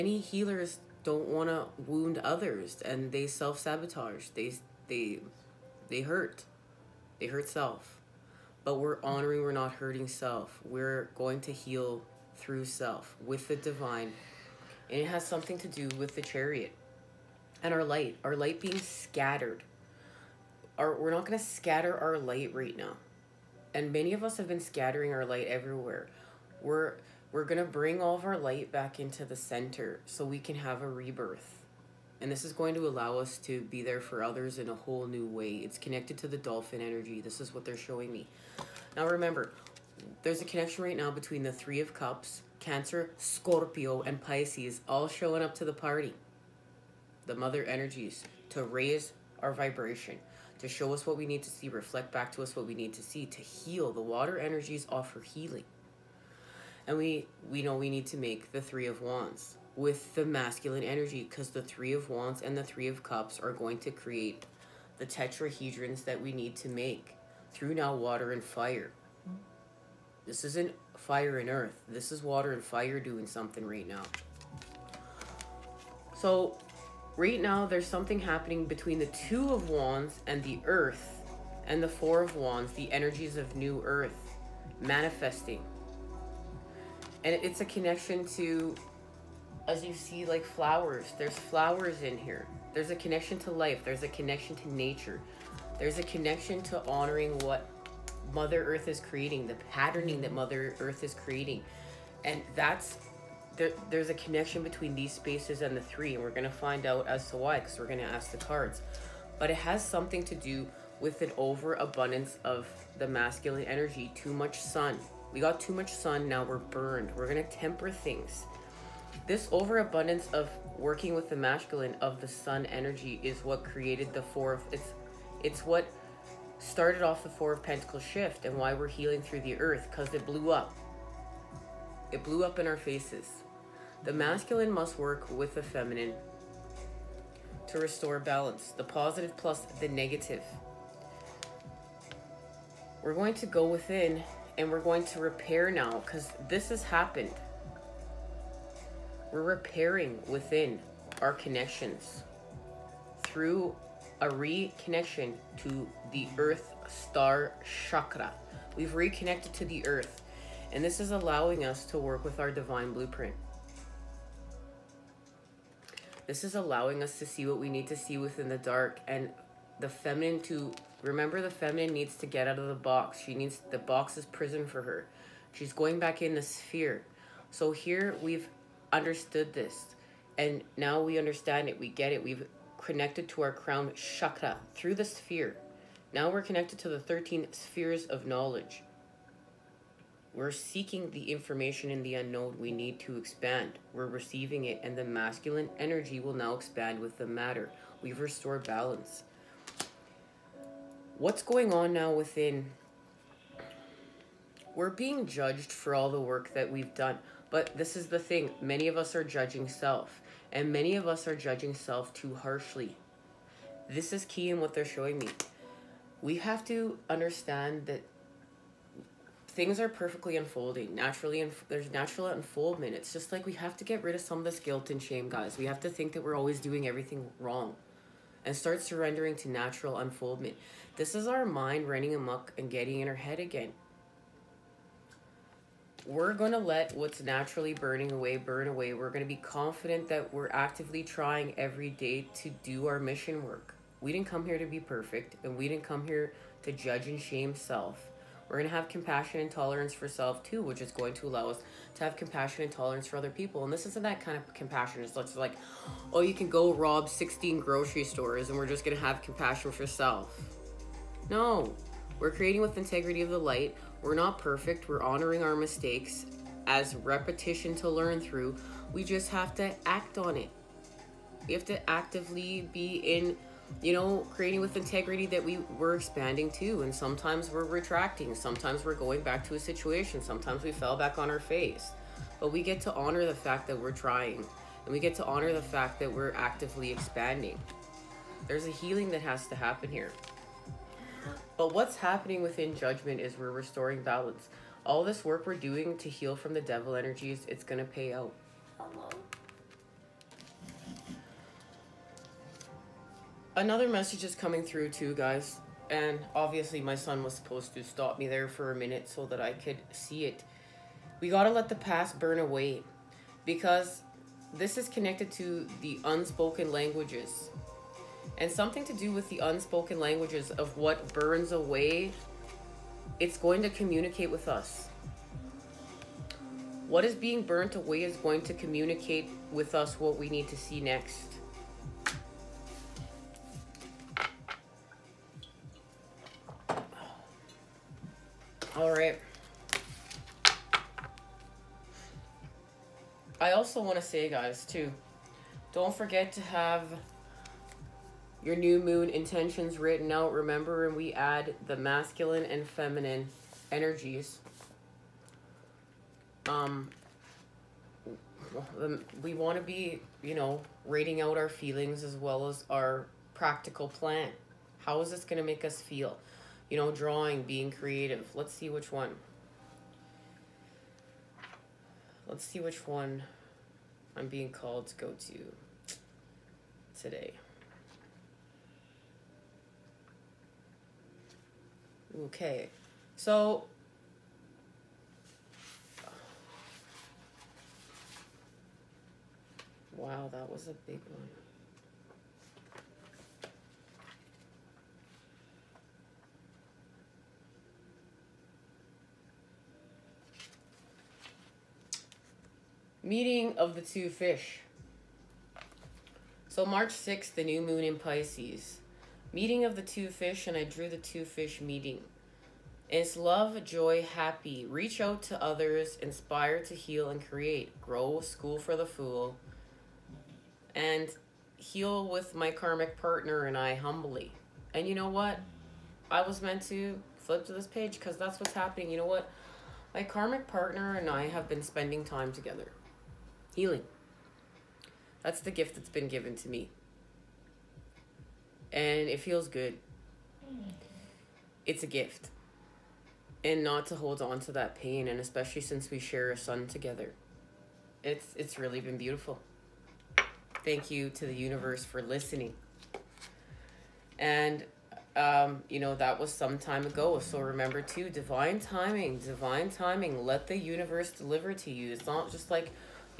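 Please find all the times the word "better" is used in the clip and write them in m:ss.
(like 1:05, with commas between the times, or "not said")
not said.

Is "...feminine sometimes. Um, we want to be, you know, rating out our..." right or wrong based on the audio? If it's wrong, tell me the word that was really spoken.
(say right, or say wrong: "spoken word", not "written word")
wrong: "energies", not "sometimes".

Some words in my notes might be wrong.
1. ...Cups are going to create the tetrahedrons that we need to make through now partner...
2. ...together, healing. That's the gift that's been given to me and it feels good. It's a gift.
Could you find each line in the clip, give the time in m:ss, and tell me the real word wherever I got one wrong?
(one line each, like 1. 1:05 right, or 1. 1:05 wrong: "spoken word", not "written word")
1. 1:03 wrong: "water", not "partner"
2. 7:12 right.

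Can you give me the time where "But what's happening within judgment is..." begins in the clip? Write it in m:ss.
4:51.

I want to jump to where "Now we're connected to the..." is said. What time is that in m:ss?
3:06.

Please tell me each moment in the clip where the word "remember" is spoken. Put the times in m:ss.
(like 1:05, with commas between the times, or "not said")
0:39, 2:51, 5:50, 7:37.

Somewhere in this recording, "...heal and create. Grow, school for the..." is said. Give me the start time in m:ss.
6:56.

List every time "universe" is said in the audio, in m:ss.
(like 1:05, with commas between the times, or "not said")
7:31, 7:40.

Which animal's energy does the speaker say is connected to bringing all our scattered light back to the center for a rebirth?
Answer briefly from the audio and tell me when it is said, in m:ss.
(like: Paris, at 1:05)
Dolphin, at 0:36.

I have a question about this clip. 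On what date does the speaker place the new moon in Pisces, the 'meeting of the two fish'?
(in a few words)
March 6th.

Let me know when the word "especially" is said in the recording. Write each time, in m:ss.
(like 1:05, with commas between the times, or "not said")
7:25.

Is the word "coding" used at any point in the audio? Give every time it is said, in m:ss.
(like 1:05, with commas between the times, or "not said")
not said.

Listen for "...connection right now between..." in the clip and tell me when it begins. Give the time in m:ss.
0:40.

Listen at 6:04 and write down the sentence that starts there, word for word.
How is this going to make us feel?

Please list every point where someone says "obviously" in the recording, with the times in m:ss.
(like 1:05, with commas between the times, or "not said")
5:06.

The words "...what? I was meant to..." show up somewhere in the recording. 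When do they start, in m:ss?
7:05.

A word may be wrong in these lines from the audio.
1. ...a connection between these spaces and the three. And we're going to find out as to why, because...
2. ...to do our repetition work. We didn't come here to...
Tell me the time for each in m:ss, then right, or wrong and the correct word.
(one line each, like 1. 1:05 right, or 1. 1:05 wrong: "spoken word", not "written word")
1. 1:44 right
2. 4:02 wrong: "mission", not "repetition".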